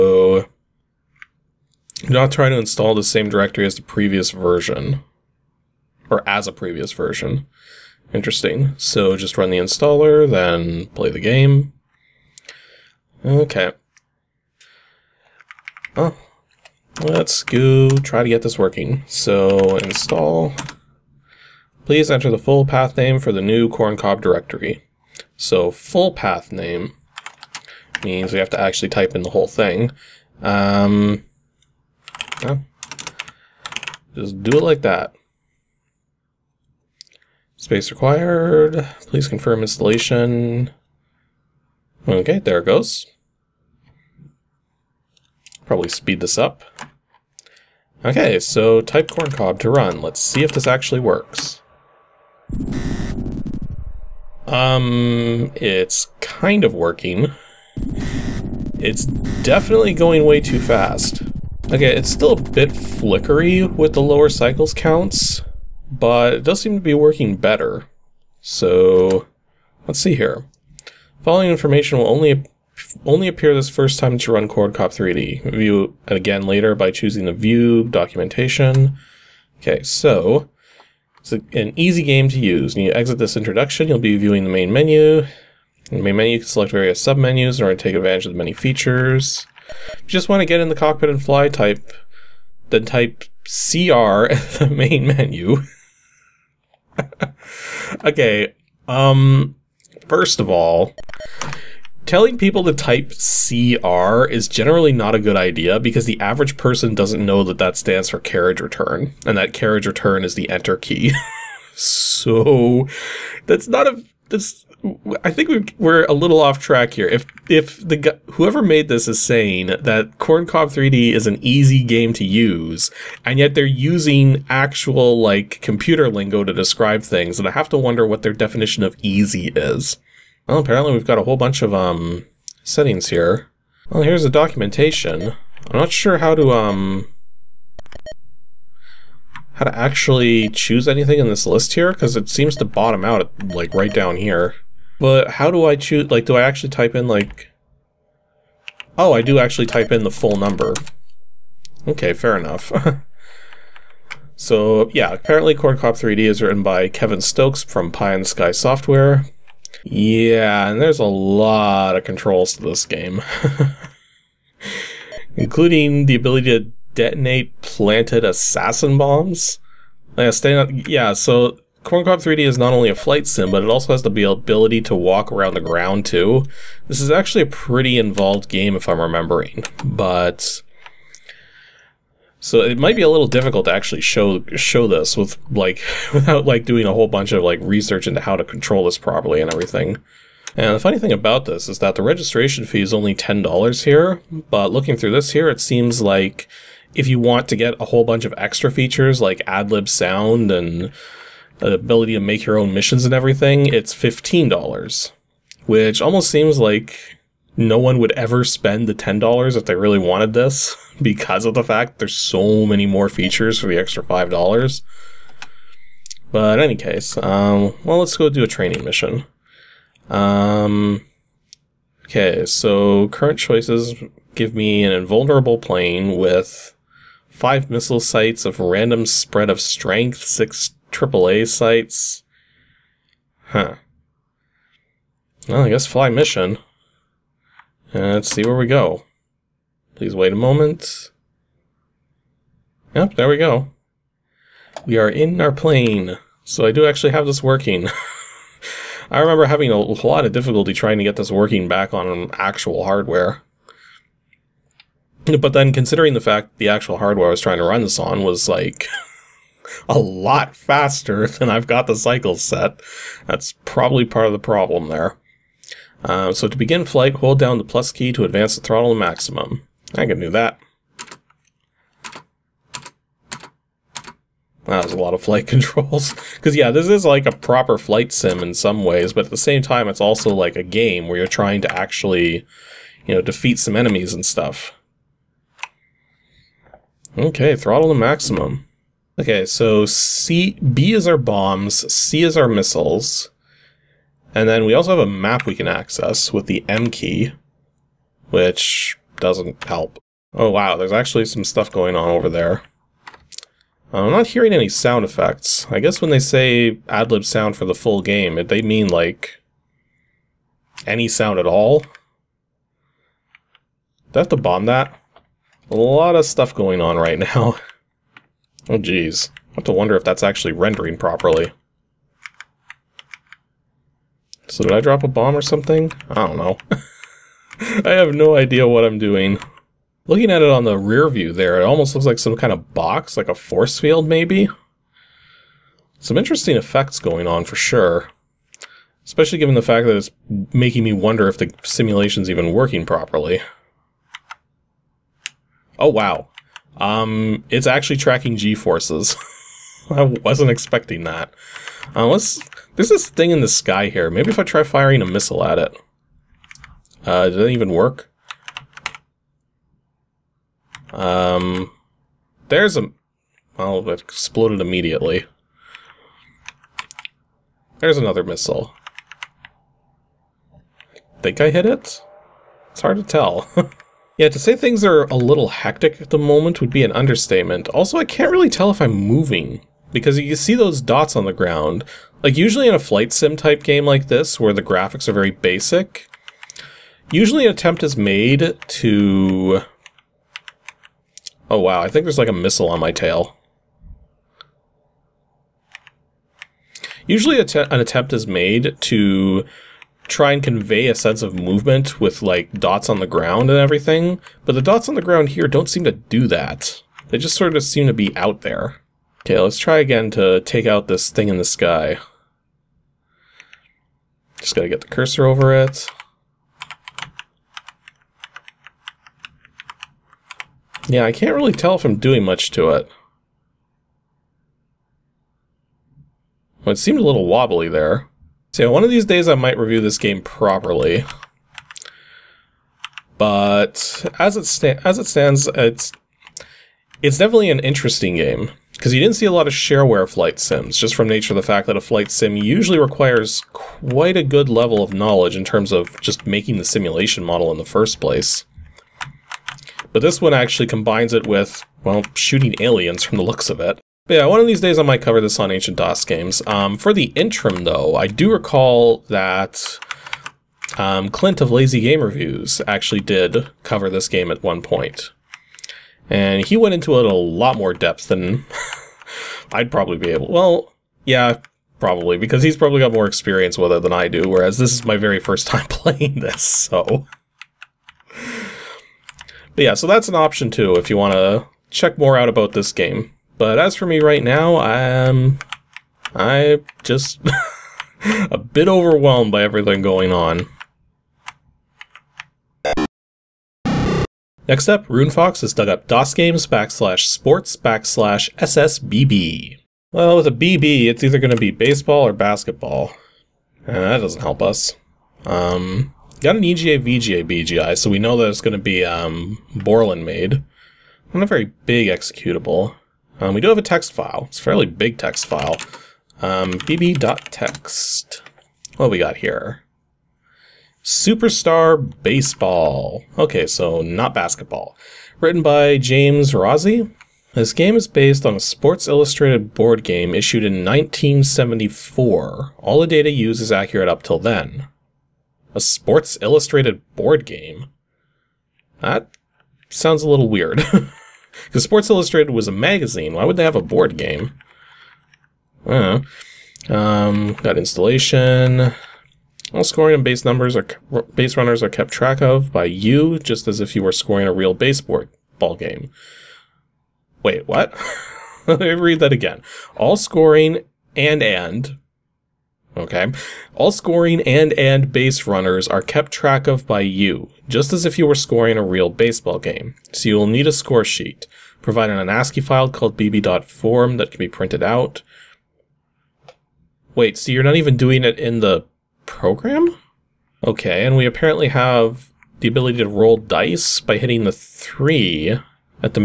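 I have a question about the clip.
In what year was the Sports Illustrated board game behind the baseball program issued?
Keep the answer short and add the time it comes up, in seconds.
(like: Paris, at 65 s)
1974, at 530 s.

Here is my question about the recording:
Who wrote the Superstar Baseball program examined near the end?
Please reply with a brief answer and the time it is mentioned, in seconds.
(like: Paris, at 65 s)
James Rossi, at 525 s.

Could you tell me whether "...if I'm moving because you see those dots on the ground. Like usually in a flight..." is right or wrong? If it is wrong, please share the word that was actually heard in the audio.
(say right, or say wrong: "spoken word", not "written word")
right.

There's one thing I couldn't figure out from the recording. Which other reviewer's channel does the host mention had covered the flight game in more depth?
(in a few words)
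Lazy Game Reviews.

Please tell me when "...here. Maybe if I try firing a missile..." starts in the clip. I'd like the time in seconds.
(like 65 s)
353 s.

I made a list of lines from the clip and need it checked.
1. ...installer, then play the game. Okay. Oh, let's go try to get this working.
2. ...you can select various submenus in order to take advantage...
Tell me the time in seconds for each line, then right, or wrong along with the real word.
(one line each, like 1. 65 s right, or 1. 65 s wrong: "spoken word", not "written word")
1. 9 s right
2. 86 s right.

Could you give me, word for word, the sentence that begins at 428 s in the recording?
So one of these days I might review this game properly.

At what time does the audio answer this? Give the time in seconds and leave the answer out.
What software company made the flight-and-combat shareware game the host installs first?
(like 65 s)
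157 s.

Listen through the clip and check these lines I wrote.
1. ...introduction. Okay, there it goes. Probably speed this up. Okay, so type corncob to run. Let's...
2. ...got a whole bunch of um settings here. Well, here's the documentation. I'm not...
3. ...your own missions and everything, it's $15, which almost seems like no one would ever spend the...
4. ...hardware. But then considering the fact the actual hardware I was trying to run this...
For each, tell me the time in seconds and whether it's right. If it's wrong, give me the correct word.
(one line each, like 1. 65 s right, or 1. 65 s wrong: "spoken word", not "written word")
1. 39 s wrong: "installation", not "introduction"
2. 131 s right
3. 202 s right
4. 252 s right.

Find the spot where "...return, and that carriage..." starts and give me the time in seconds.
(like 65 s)
108 s.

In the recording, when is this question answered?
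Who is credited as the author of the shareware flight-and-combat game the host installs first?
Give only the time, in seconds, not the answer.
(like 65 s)
156 s.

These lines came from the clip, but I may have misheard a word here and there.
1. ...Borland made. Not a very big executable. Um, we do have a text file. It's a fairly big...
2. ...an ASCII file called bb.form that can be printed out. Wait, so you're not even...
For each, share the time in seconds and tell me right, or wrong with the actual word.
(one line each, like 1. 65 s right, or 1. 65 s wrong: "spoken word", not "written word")
1. 509 s right
2. 571 s right.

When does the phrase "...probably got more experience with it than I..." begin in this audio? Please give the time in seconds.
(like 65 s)
472 s.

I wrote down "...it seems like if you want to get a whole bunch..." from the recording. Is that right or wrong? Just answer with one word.
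right.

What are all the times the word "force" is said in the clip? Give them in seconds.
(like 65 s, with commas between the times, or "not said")
333 s, 348 s.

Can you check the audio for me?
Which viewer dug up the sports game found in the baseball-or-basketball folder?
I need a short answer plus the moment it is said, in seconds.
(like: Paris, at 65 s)
RuneFox, at 494 s.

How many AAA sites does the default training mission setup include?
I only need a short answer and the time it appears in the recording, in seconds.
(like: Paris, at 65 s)
6, at 230 s.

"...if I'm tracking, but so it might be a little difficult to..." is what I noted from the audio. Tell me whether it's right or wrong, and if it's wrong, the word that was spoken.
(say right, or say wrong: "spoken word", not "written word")
wrong: "remembering", not "tracking".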